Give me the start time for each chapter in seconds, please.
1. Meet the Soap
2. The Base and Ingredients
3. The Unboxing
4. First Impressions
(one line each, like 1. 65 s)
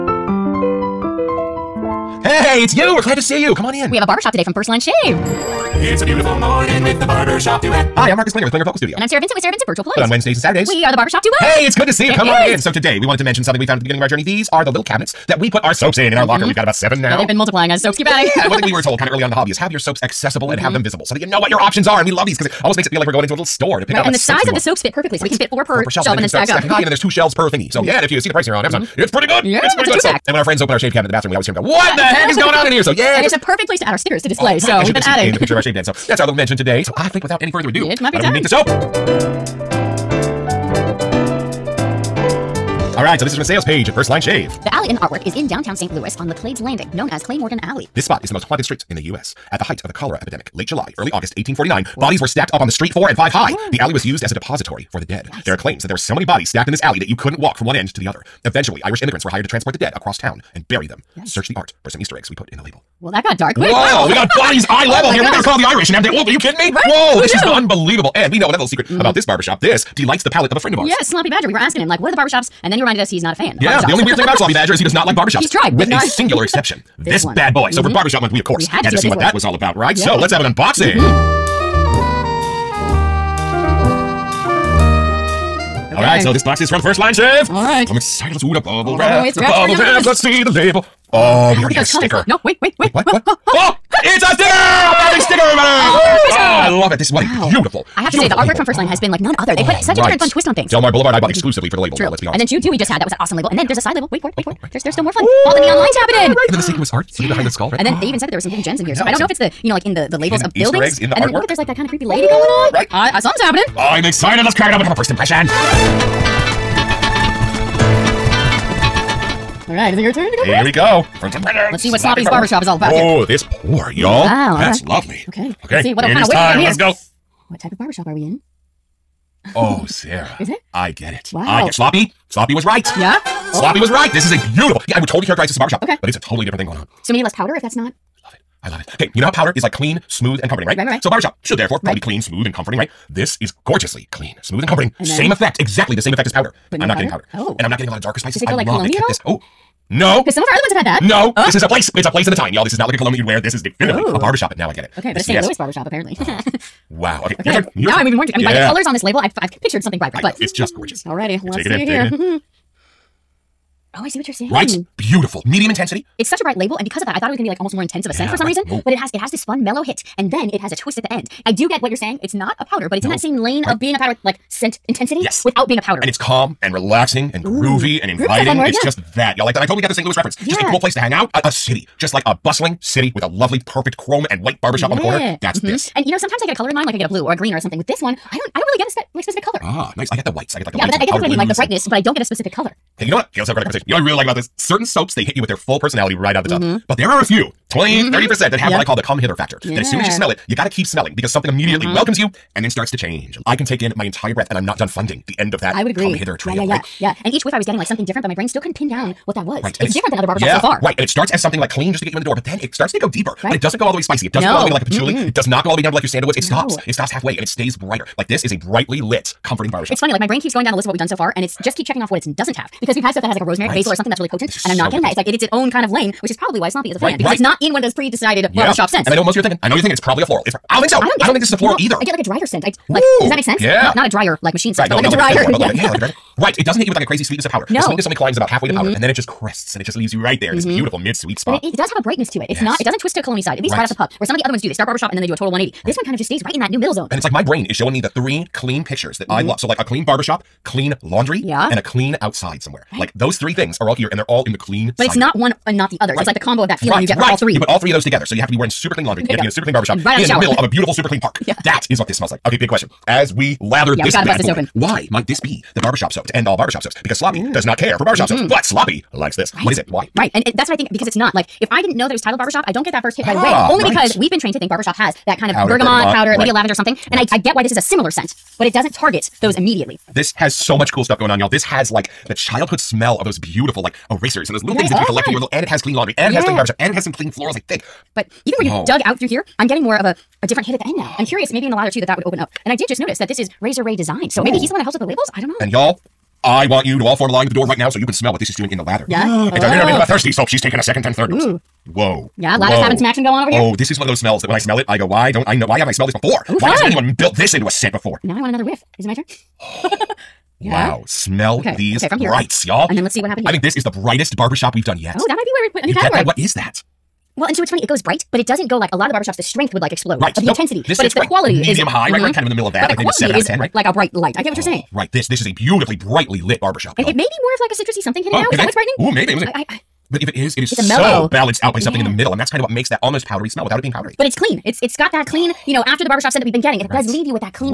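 1. 38 s
2. 66 s
3. 81 s
4. 115 s.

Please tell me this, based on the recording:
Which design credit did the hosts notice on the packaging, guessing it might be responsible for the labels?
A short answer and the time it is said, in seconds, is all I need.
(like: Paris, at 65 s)
Razor Ray Design, at 293 s.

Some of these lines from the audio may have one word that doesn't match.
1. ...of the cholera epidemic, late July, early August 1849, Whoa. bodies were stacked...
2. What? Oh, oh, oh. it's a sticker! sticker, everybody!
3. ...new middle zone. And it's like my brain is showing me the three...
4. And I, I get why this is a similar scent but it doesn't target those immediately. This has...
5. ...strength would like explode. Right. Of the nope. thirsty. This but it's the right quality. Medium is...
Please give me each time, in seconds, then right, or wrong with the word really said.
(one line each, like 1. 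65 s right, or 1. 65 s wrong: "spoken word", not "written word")
1. 49 s right
2. 93 s right
3. 246 s right
4. 277 s right
5. 319 s wrong: "intensity", not "thirsty".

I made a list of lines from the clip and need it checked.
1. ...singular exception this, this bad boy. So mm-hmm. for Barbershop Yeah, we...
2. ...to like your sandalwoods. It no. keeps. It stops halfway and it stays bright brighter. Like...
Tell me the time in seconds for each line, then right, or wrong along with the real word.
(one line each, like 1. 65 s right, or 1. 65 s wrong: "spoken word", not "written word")
1. 76 s wrong: "Month", not "Yeah"
2. 215 s wrong: "stops", not "keeps".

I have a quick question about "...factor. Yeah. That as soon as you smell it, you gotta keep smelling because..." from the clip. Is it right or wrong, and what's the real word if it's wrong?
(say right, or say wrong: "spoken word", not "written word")
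right.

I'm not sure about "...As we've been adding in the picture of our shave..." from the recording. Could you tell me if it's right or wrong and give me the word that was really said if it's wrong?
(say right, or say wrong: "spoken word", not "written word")
right.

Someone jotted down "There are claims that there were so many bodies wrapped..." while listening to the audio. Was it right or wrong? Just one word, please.
wrong.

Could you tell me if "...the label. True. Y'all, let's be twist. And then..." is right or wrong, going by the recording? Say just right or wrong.
wrong.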